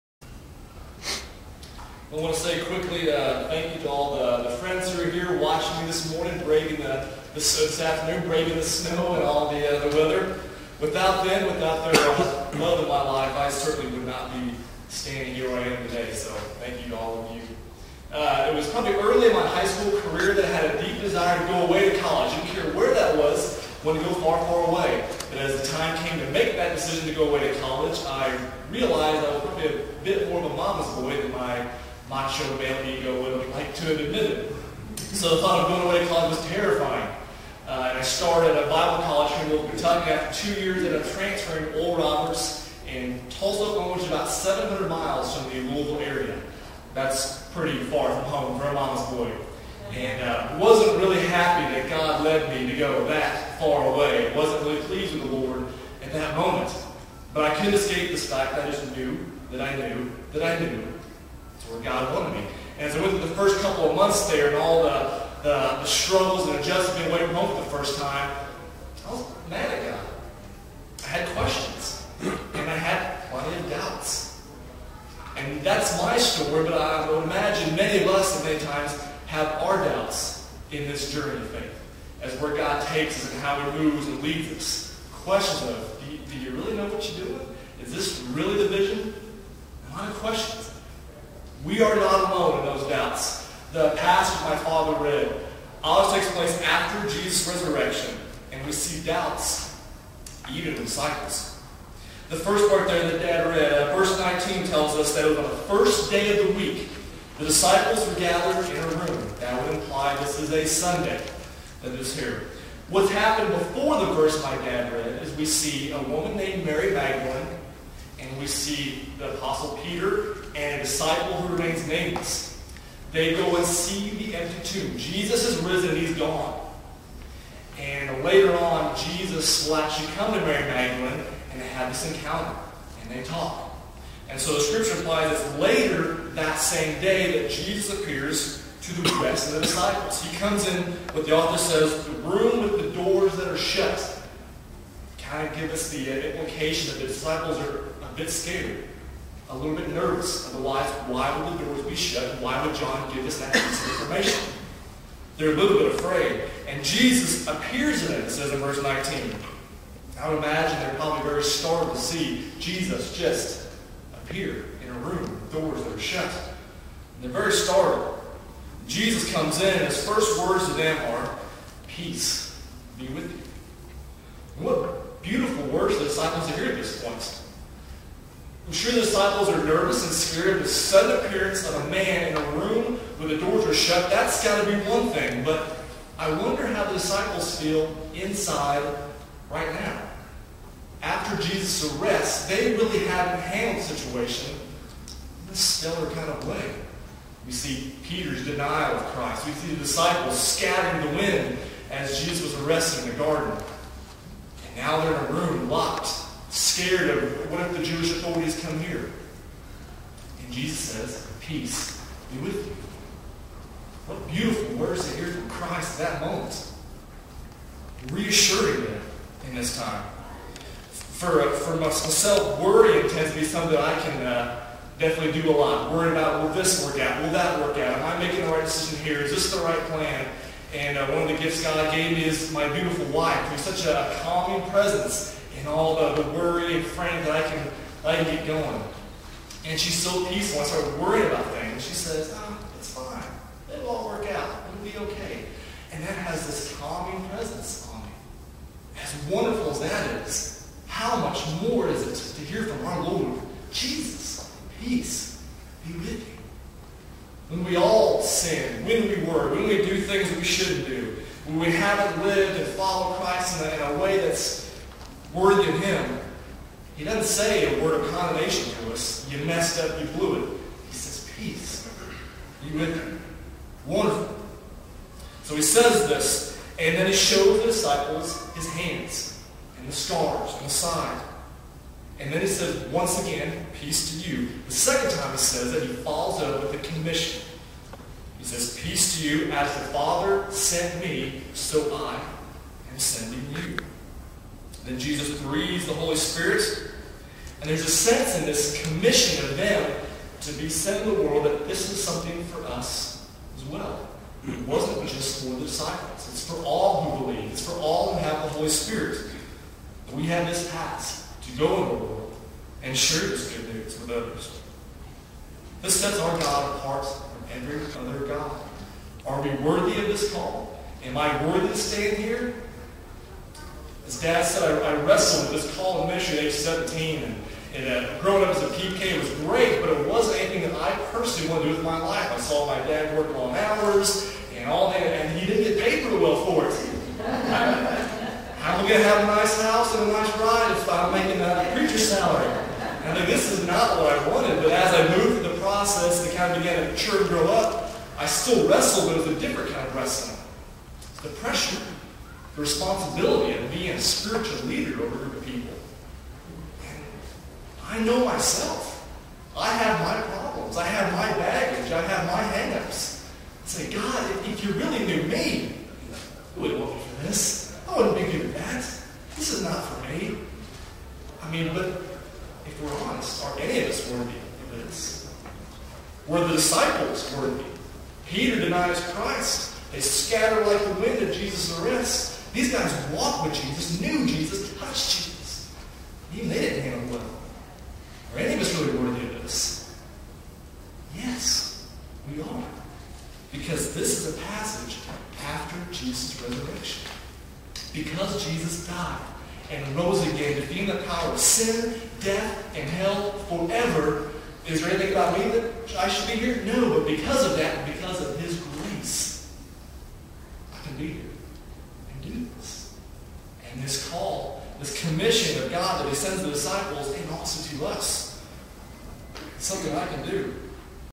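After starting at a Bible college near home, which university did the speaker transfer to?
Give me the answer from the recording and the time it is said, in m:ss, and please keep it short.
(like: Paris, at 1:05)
Oral Roberts, at 0:41.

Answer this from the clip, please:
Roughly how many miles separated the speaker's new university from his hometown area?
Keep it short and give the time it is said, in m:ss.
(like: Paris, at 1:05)
700, at 0:44.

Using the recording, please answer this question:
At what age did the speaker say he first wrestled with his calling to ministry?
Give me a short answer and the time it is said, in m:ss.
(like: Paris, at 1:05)
17, at 5:26.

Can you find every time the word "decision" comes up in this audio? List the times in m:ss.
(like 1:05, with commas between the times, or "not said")
0:26, 3:48.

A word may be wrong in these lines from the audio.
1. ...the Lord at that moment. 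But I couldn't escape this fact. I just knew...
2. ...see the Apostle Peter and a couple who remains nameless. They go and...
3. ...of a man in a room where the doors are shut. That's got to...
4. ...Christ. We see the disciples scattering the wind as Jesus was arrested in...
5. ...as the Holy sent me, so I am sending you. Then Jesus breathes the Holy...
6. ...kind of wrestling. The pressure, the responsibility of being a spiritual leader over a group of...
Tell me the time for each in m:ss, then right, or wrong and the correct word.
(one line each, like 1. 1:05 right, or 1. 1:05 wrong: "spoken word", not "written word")
1. 0:55 right
2. 1:58 wrong: "disciple", not "couple"
3. 3:01 right
4. 3:19 right
5. 4:49 wrong: "Father", not "Holy"
6. 5:49 right.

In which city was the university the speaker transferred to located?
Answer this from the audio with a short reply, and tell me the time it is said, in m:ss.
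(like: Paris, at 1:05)
Tulsa, Oklahoma, at 0:43.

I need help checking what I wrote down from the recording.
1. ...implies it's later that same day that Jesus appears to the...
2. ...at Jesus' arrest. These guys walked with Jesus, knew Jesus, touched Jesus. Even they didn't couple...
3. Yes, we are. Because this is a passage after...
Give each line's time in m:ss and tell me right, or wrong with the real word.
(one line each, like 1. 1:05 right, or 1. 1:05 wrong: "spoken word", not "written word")
1. 2:14 right
2. 6:21 wrong: "handle", not "couple"
3. 6:31 right.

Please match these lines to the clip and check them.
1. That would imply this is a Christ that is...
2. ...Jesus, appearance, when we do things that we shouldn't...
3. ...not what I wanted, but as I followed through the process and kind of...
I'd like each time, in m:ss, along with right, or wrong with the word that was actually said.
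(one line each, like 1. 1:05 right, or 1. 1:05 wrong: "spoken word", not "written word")
1. 1:49 wrong: "Sunday", not "Christ"
2. 4:13 wrong: "peace", not "appearance"
3. 5:43 wrong: "moved", not "followed".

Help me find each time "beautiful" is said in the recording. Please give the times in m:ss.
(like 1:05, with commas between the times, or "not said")
2:55, 3:34, 3:52.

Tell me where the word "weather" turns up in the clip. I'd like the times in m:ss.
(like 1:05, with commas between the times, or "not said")
0:09.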